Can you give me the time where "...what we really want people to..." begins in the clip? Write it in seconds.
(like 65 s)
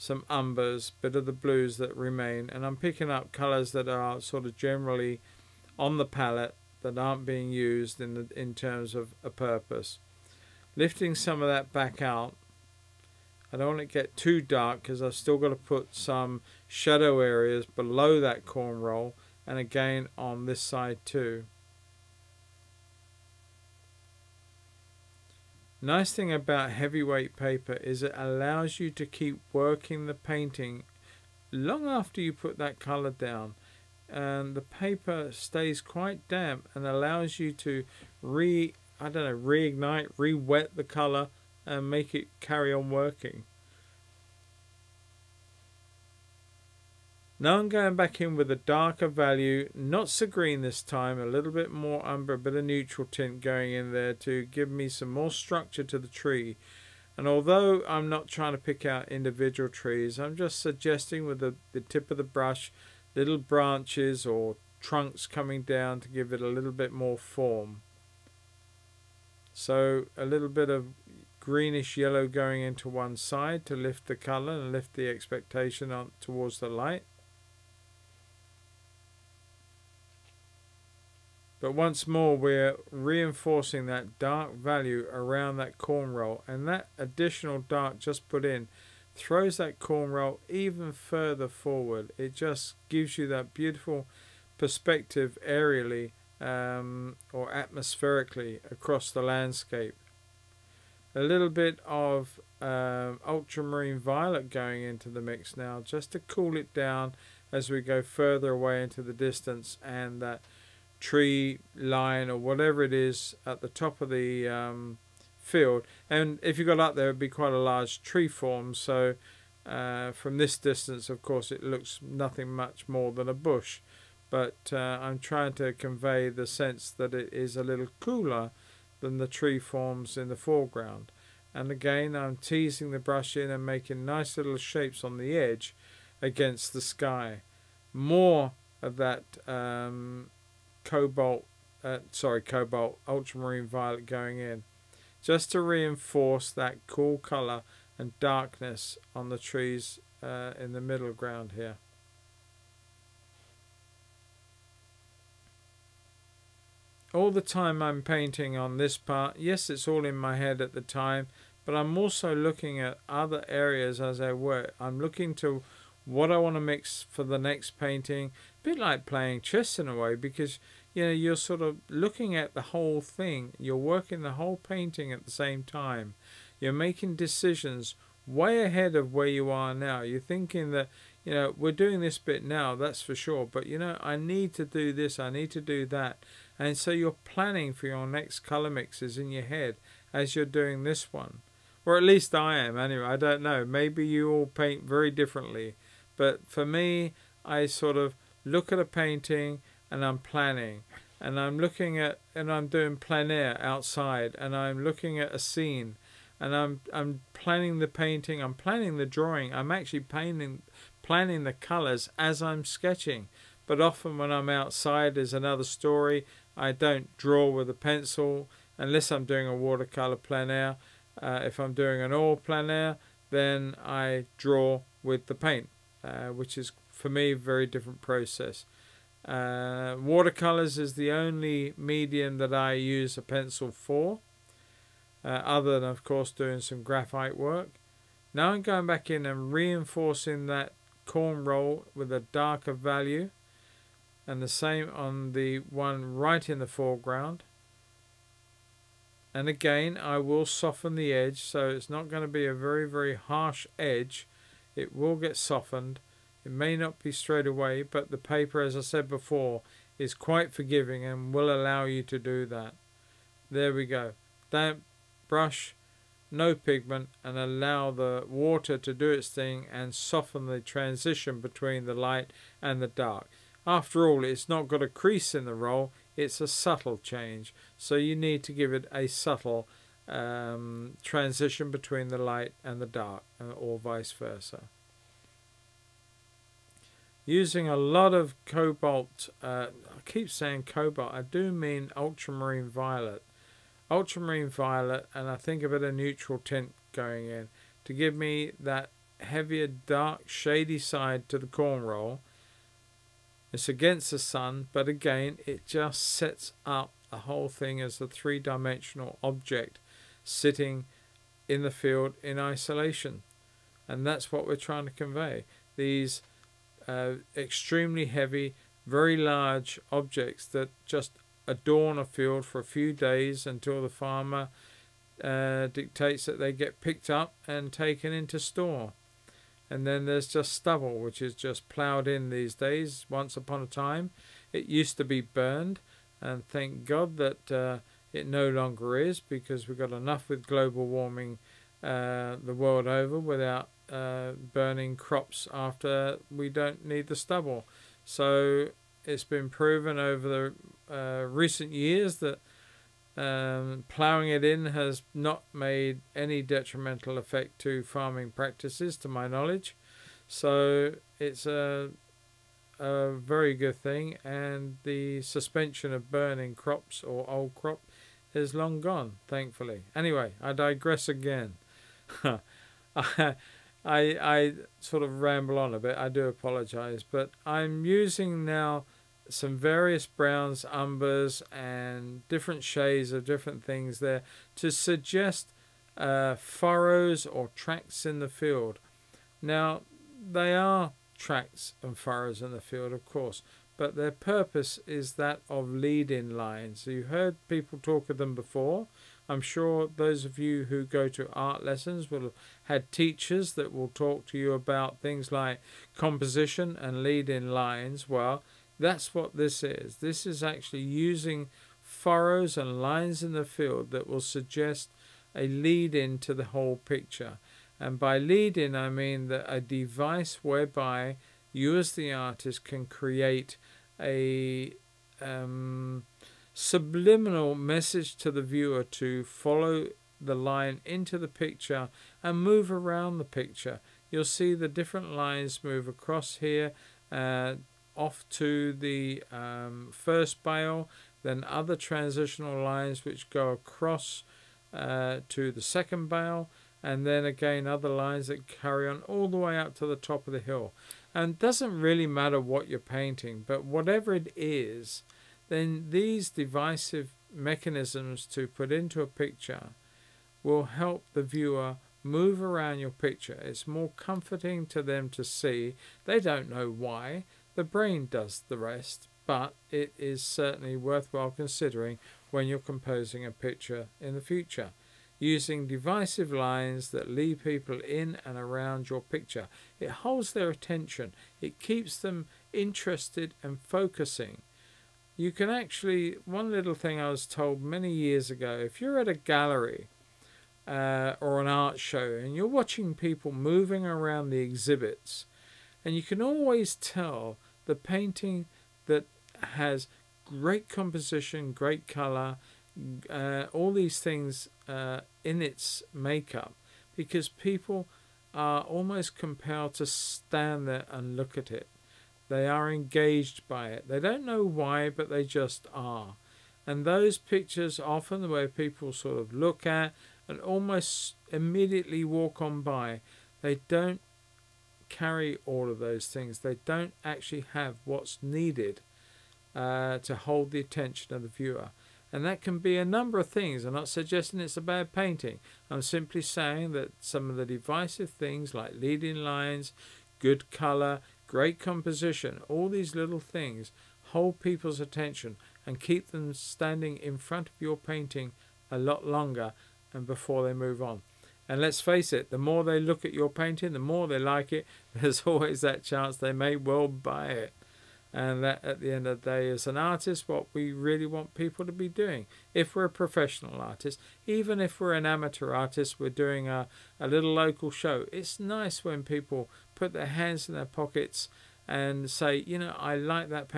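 560 s.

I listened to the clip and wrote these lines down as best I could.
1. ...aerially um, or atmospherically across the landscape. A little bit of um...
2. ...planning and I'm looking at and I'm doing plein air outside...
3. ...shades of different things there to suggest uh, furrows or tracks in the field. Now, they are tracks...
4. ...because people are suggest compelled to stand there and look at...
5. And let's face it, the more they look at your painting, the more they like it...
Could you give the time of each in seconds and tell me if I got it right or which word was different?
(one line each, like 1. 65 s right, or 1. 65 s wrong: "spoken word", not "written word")
1. 95 s right
2. 200 s right
3. 382 s right
4. 506 s wrong: "almost", not "suggest"
5. 551 s right.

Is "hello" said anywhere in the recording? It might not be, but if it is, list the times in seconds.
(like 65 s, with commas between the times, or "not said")
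not said.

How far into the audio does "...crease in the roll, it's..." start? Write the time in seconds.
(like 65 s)
274 s.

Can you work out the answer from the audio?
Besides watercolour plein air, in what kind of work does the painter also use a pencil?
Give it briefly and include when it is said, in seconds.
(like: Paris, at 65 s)
Graphite work, at 236 s.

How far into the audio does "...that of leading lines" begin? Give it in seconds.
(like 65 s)
395 s.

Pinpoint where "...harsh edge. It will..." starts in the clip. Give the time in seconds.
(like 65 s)
253 s.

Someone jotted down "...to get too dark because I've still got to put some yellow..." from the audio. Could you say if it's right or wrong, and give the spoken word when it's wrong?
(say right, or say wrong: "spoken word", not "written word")
wrong: "shadow", not "yellow".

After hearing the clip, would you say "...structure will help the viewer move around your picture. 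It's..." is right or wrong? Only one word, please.
wrong.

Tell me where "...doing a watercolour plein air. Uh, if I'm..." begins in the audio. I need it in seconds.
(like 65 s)
219 s.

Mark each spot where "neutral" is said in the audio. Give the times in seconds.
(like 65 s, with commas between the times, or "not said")
52 s, 295 s.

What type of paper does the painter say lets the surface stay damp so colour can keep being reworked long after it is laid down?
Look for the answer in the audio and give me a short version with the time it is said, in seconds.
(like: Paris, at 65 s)
Heavyweight paper, at 26 s.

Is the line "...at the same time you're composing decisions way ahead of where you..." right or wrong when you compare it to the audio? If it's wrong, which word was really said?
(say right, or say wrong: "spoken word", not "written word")
wrong: "making", not "composing".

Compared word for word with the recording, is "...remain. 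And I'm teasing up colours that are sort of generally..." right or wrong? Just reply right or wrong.
wrong.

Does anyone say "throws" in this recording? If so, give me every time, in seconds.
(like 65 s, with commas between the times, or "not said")
89 s.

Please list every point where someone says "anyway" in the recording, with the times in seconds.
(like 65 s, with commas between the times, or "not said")
192 s, 369 s.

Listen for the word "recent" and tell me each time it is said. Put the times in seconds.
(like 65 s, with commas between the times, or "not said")
351 s.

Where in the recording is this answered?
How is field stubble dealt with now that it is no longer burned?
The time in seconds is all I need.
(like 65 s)
331 s.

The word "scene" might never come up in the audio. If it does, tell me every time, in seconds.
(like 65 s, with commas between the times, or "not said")
205 s.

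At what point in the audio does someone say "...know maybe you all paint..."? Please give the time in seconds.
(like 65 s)
193 s.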